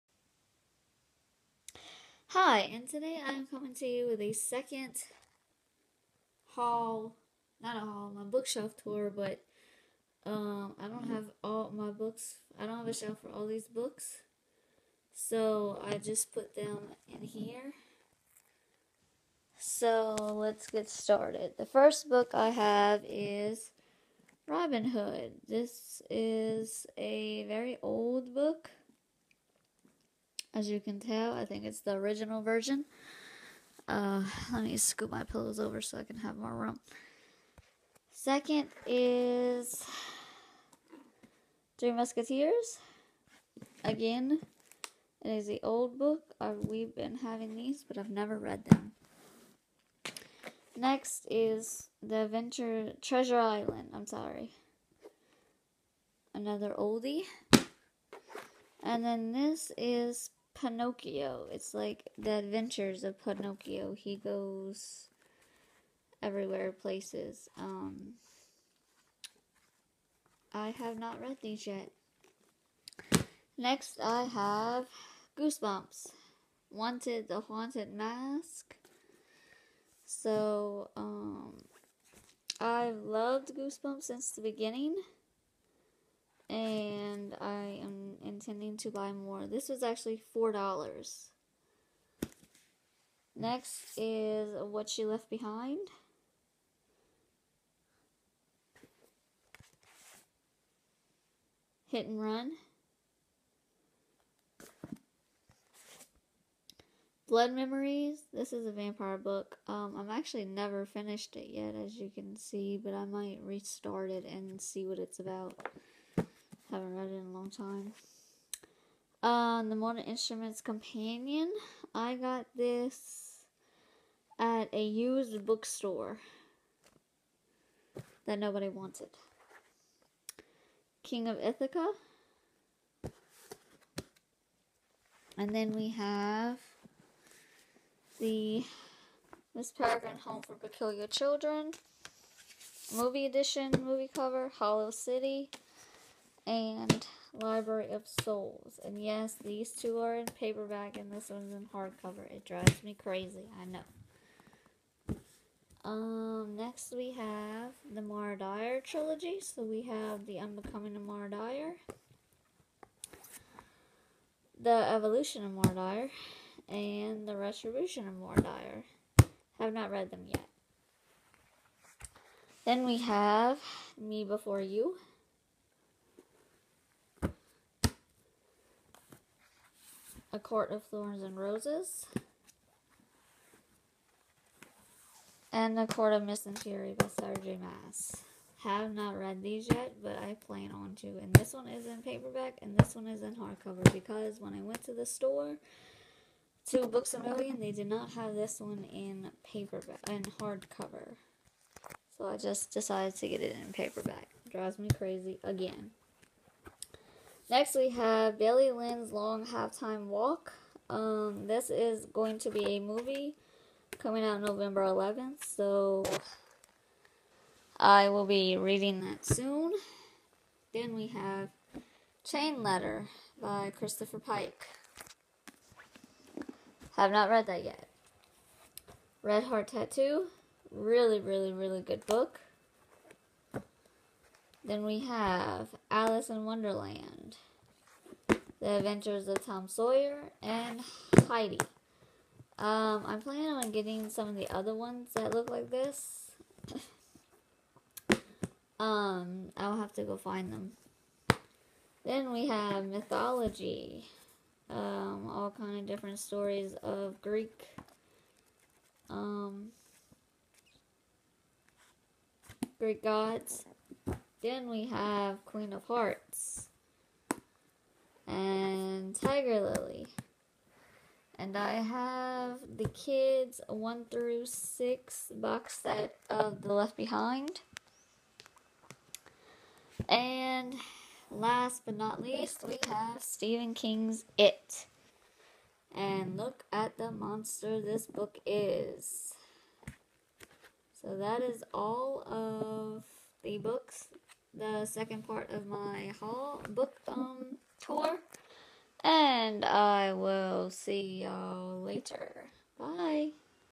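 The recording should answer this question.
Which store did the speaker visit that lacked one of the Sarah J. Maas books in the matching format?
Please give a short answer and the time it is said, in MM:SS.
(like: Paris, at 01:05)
Books a Million, at 03:16.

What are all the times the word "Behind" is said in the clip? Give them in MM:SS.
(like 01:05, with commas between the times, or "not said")
01:35, 04:36.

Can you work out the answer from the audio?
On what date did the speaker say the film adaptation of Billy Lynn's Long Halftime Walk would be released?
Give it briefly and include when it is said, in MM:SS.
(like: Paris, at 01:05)
November 11th, at 03:34.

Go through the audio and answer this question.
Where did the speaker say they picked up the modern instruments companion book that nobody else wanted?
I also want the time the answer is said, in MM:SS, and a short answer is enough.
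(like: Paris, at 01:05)
a used bookstore, at 02:04.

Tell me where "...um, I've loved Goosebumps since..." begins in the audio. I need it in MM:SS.
01:20.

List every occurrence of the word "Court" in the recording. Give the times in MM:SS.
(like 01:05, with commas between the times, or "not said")
03:00, 03:05.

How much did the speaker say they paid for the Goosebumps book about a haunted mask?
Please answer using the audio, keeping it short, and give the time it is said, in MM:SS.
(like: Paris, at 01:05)
$4, at 01:30.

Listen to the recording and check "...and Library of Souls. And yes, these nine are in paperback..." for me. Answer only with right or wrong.
wrong.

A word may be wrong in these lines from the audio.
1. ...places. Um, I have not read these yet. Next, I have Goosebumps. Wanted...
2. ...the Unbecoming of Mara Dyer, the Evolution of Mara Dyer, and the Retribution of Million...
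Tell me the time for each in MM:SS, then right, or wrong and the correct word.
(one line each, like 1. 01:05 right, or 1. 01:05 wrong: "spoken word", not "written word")
1. 01:06 right
2. 02:40 wrong: "Mara", not "Million".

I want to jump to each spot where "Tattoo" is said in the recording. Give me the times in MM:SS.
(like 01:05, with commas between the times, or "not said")
03:49.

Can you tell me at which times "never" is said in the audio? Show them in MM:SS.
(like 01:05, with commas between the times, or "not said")
00:48, 01:50.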